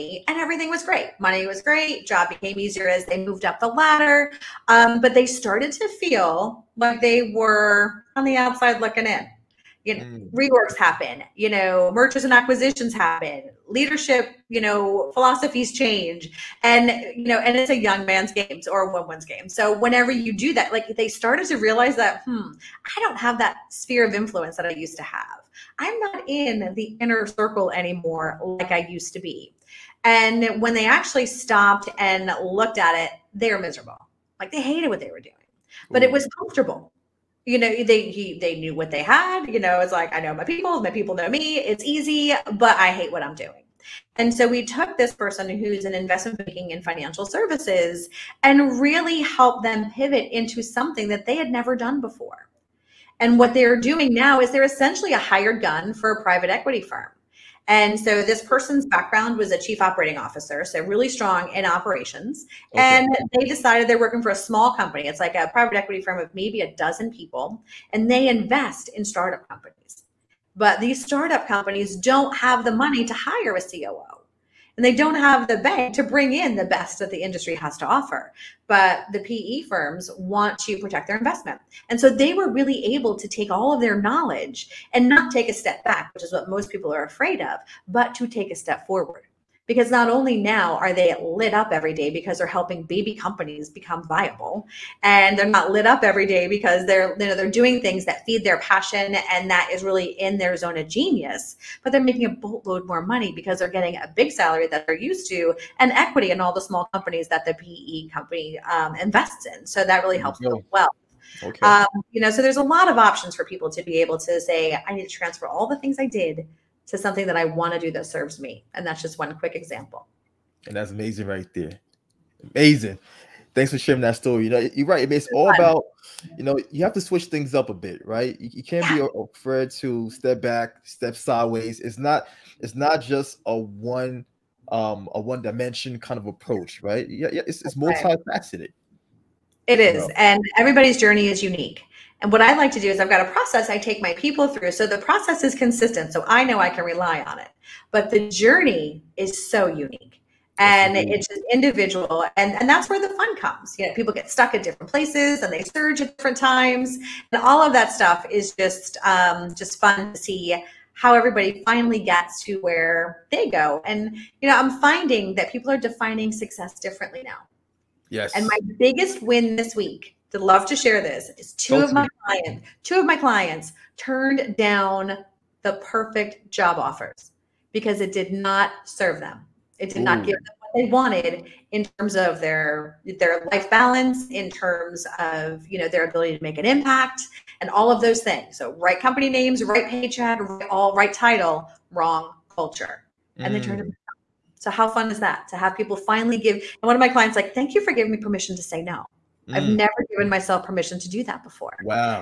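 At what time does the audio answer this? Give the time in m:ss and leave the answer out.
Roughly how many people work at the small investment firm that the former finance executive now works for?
1:06.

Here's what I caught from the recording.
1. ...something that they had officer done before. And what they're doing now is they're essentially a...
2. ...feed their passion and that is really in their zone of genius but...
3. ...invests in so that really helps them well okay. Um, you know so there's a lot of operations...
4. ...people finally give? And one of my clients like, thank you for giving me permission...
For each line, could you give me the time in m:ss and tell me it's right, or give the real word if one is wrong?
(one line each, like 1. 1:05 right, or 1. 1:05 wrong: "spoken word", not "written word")
1. 0:50 wrong: "never", not "officer"
2. 1:38 right
3. 1:48 wrong: "options", not "operations"
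4. 3:15 right.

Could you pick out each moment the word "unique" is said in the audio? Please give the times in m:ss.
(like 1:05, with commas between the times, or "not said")
2:21, 2:29.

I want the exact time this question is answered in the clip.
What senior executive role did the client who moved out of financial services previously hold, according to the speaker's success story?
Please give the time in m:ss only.
0:59.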